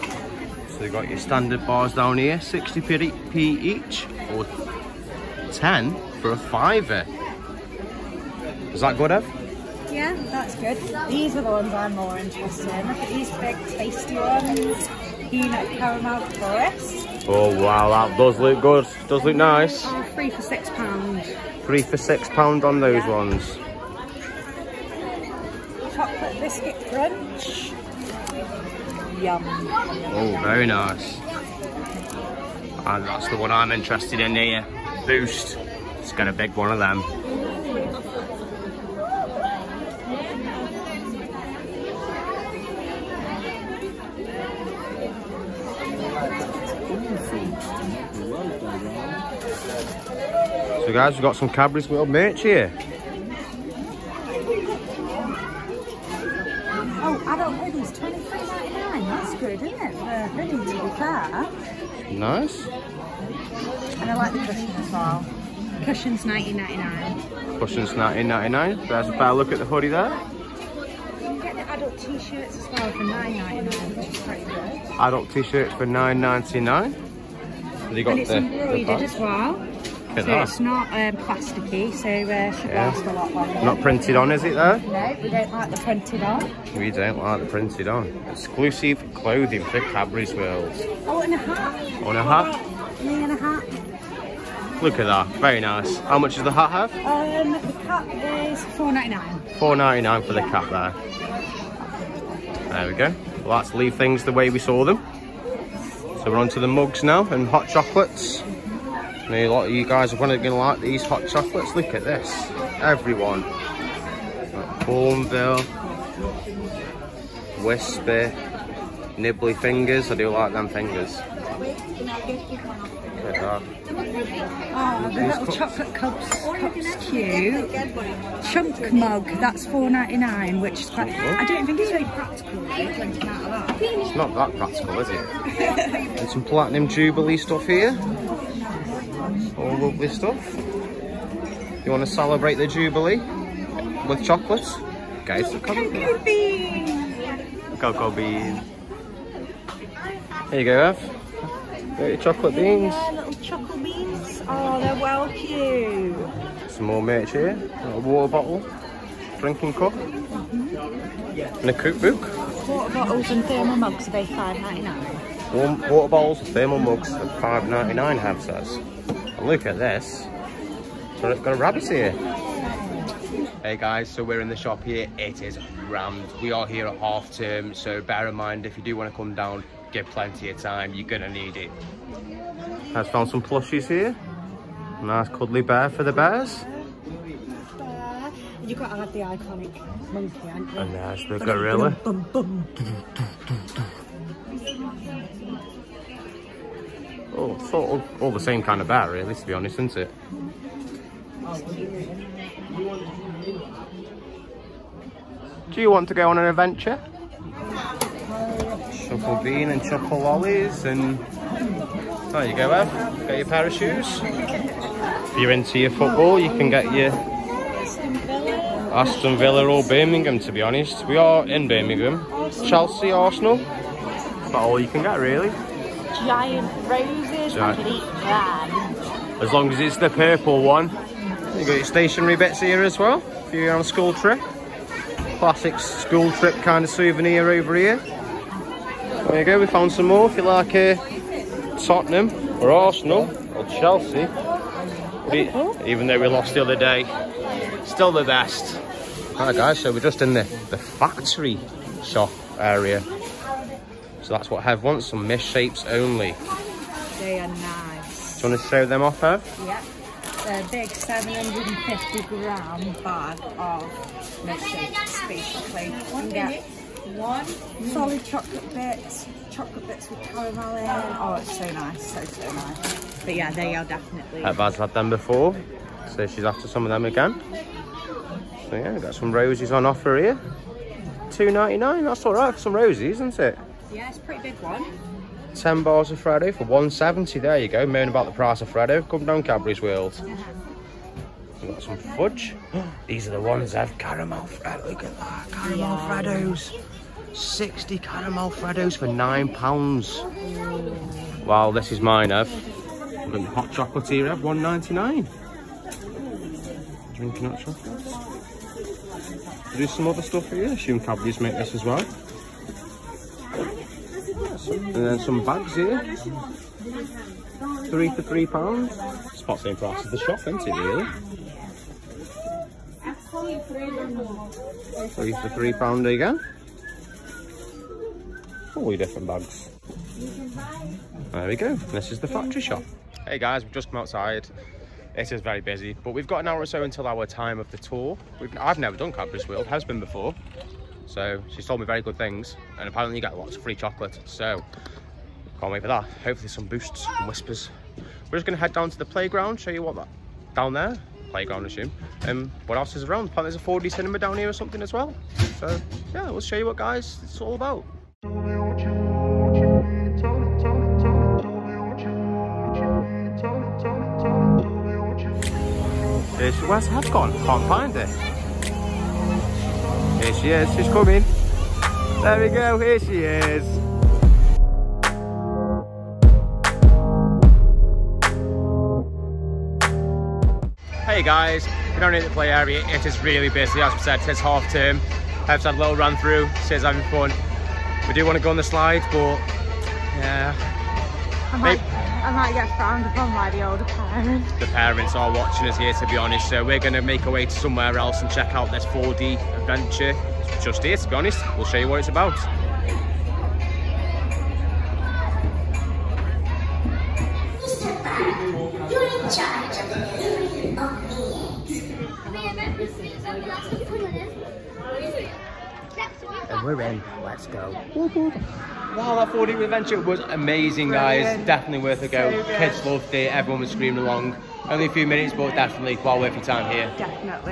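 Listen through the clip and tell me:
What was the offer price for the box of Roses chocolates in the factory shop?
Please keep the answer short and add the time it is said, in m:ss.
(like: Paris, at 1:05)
£2.99, at 4:41.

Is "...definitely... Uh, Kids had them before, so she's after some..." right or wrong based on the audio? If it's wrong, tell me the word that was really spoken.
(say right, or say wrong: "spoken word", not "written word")
wrong: "Baz", not "Kids".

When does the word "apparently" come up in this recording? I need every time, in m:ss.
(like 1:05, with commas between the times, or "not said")
5:42, 5:53.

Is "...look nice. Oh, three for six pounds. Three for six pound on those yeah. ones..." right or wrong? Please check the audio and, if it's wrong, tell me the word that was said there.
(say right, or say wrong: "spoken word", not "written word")
right.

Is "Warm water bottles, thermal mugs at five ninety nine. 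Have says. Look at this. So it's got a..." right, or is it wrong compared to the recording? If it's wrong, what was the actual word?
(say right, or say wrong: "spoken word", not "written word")
right.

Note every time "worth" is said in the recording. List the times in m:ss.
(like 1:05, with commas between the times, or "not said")
7:01, 7:06.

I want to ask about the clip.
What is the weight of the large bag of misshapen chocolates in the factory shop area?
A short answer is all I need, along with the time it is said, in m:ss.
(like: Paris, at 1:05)
750 grams, at 4:20.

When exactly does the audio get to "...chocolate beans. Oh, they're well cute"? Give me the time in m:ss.
2:33.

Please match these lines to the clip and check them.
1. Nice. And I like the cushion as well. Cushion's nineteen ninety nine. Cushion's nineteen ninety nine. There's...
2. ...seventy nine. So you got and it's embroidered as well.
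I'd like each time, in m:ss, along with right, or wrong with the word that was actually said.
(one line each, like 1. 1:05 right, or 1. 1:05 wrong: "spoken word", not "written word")
1. 1:02 right
2. 1:16 wrong: "ninety", not "seventy".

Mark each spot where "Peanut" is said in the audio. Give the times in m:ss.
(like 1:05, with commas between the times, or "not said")
0:15.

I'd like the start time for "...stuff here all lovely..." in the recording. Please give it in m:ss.
2:17.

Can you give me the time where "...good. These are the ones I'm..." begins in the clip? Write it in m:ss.
0:10.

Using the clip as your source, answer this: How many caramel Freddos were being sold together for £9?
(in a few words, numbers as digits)
60.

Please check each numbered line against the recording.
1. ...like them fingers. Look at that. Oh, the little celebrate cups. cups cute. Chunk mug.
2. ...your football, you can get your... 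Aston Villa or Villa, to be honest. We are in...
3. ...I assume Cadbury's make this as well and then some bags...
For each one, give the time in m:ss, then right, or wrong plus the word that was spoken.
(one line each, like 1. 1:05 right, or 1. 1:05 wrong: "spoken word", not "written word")
1. 2:00 wrong: "chocolate", not "celebrate"
2. 3:35 wrong: "Birmingham", not "Villa"
3. 5:10 right.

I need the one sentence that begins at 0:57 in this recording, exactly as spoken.
Oh, adult hoodies, twenty three ninety nine.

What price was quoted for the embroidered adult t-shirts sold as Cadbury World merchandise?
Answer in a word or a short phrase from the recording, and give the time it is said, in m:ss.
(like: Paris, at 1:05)
£9.99, at 1:13.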